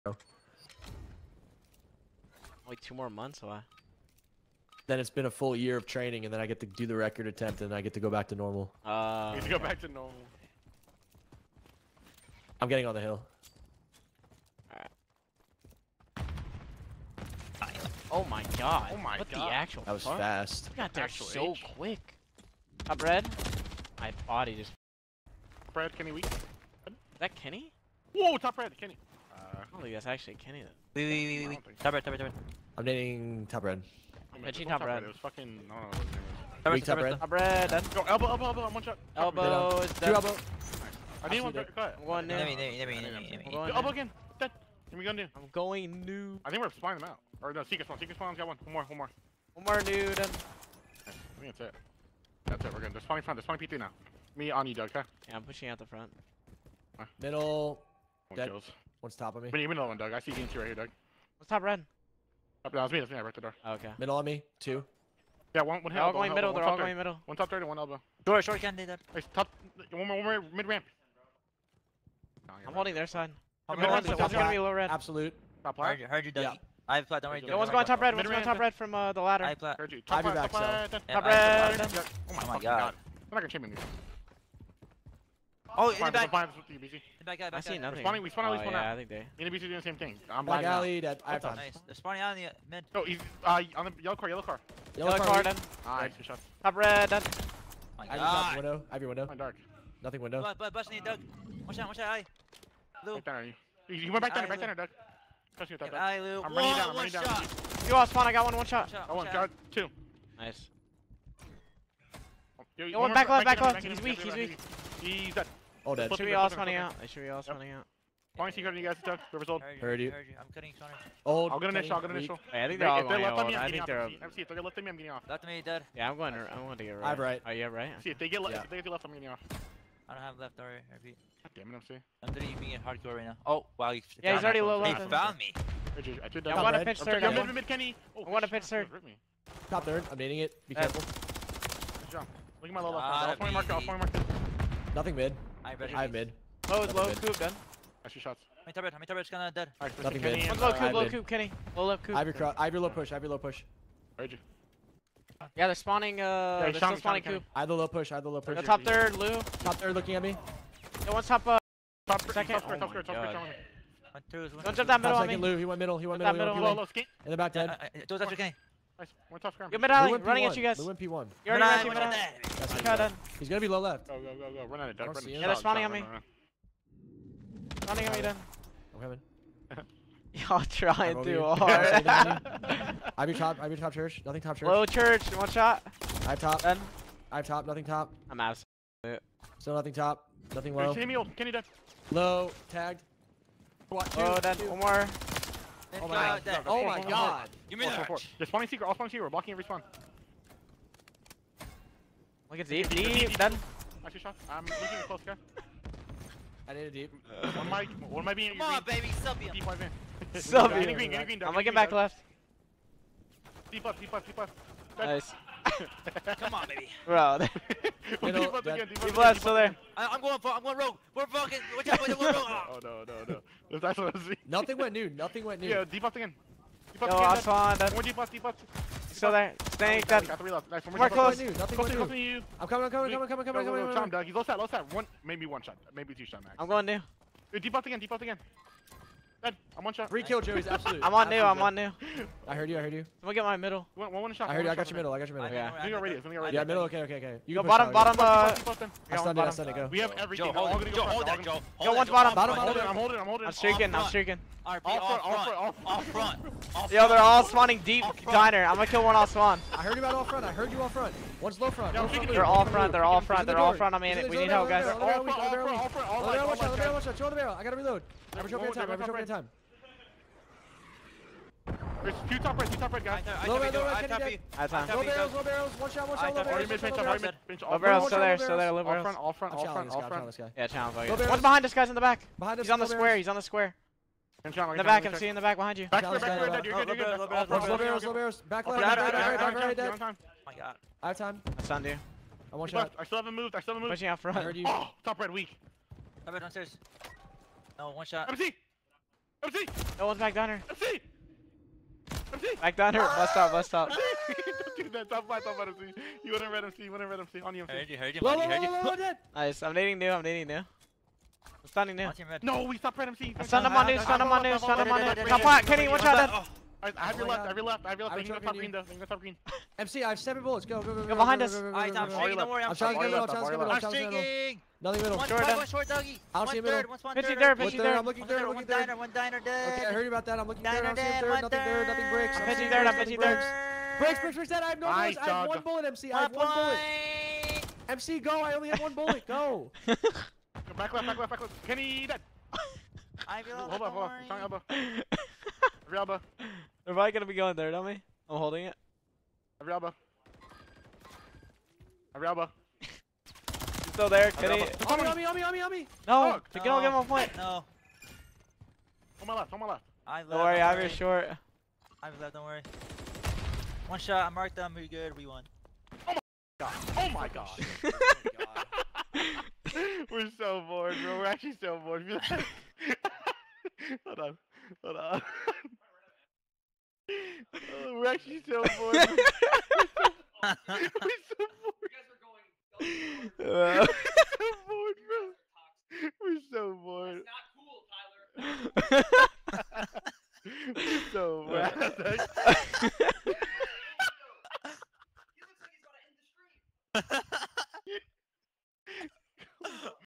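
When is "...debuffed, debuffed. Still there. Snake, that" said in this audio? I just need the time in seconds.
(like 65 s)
228 s.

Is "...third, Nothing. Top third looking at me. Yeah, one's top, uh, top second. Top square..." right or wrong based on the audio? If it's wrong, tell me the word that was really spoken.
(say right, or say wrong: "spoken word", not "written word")
wrong: "Lou", not "Nothing".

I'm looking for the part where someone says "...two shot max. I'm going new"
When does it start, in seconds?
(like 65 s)
236 s.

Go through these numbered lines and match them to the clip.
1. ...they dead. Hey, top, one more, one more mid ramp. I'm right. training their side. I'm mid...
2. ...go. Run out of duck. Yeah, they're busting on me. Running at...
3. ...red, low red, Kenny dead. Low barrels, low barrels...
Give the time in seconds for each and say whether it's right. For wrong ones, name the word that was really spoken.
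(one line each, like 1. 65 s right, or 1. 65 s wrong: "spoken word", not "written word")
1. 68 s wrong: "holding", not "training"
2. 174 s wrong: "spawning", not "busting"
3. 273 s right.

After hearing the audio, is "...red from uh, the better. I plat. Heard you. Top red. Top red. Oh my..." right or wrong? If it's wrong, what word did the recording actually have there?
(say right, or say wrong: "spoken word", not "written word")
wrong: "ladder", not "better".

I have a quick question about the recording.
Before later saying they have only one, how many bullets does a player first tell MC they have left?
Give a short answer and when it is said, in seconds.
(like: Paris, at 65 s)
7, at 320 s.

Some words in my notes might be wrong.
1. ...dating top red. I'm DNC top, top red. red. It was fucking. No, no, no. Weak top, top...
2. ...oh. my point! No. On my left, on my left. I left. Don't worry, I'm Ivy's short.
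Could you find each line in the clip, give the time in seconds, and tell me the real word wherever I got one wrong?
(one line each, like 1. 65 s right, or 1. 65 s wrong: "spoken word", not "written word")
1. 32 s wrong: "Reggie", not "DNC"
2. 356 s right.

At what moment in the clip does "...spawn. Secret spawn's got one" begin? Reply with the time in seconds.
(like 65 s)
47 s.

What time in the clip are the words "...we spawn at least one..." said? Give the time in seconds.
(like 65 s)
88 s.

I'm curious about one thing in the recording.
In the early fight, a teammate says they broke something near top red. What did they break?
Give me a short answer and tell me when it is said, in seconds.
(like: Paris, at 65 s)
the door, at 63 s.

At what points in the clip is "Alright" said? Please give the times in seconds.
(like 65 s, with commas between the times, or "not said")
149 s, 316 s, 321 s.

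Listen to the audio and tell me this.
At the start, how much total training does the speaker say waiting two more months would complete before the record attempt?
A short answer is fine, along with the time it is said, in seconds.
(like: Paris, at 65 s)
a full year, at 5 s.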